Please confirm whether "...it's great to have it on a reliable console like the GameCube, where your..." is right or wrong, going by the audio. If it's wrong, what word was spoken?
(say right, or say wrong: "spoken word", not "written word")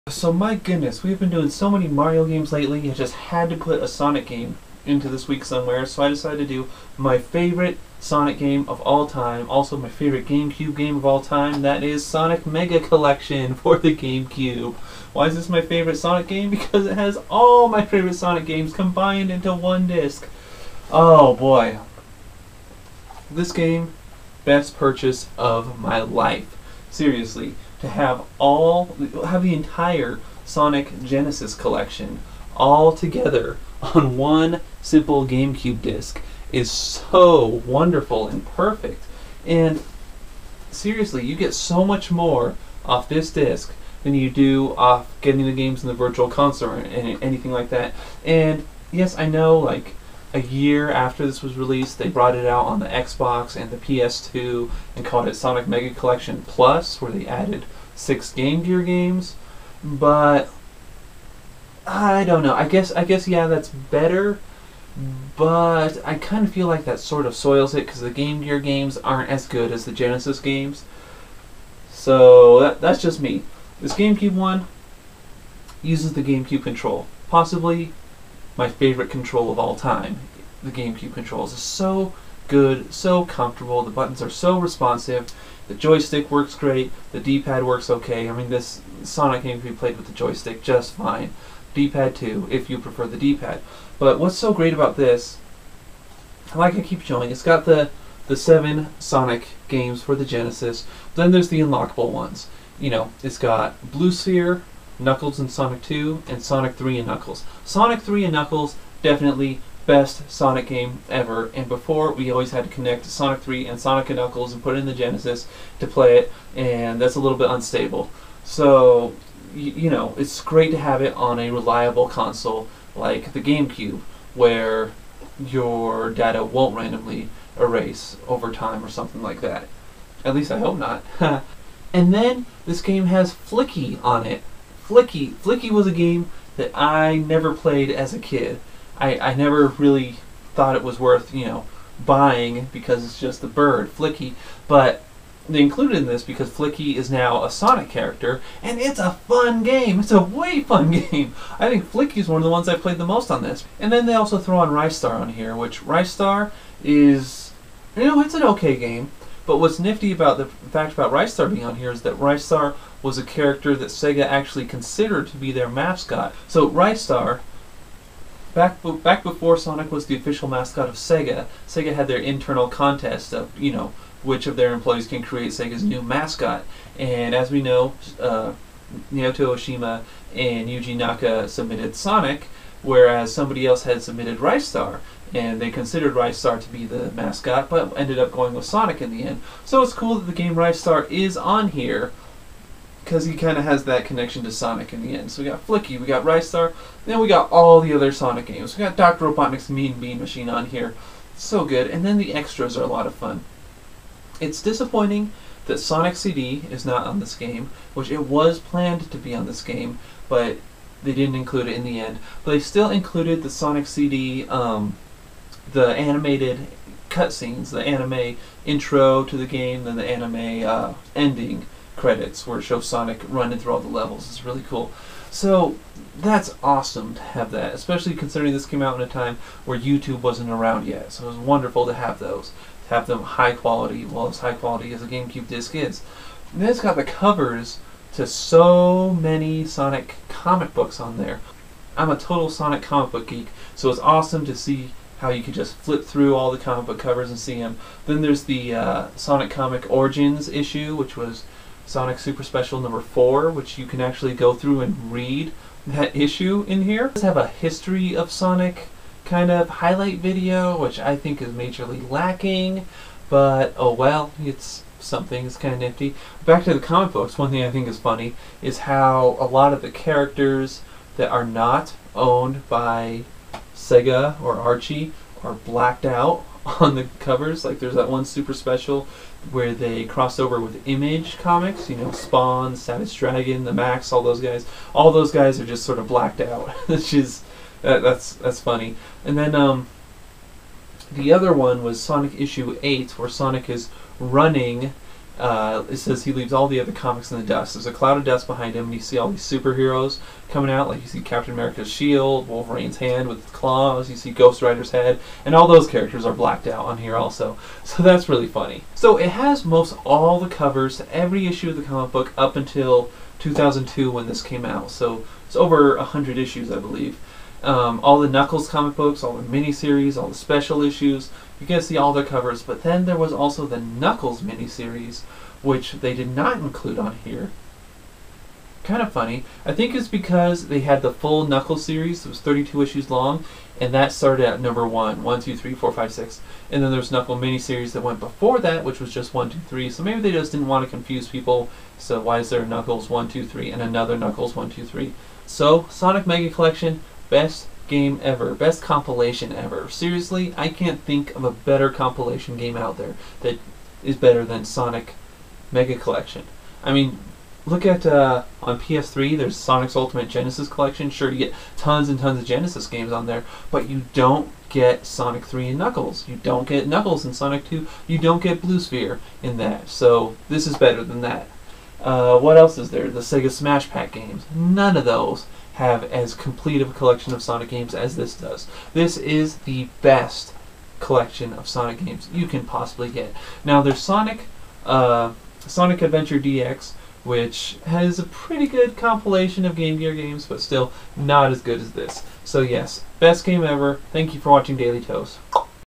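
right.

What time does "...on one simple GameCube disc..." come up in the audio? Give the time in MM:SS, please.
00:33.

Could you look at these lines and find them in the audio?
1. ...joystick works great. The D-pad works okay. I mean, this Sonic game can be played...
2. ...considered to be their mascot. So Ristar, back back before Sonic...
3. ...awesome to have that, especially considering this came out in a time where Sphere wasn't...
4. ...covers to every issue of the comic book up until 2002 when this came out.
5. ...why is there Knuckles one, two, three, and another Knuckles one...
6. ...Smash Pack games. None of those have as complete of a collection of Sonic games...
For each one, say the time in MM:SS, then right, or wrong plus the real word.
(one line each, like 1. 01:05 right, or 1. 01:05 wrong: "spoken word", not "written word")
1. 01:25 right
2. 02:44 right
3. 03:46 wrong: "YouTube", not "Sphere"
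4. 05:10 right
5. 05:42 right
6. 06:13 right.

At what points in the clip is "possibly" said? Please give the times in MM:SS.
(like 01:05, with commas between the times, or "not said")
01:17, 06:22.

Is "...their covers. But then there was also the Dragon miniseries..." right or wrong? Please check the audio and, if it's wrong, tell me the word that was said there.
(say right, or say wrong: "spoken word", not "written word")
wrong: "Knuckles", not "Dragon".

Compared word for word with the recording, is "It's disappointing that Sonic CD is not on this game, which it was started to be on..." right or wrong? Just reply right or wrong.
wrong.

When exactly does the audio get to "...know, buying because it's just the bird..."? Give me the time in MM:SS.
02:21.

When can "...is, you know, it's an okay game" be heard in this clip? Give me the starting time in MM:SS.
02:36.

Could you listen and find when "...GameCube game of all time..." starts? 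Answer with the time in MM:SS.
00:10.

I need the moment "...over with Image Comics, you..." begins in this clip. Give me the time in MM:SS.
04:40.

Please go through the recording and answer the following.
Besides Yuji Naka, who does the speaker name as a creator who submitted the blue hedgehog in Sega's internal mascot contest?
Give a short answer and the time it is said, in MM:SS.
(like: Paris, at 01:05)
Naoto Oshima, at 02:59.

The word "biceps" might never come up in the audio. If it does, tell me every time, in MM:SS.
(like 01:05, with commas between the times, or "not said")
not said.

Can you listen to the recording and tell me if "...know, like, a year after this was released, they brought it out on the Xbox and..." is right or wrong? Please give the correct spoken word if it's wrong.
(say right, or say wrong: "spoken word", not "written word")
right.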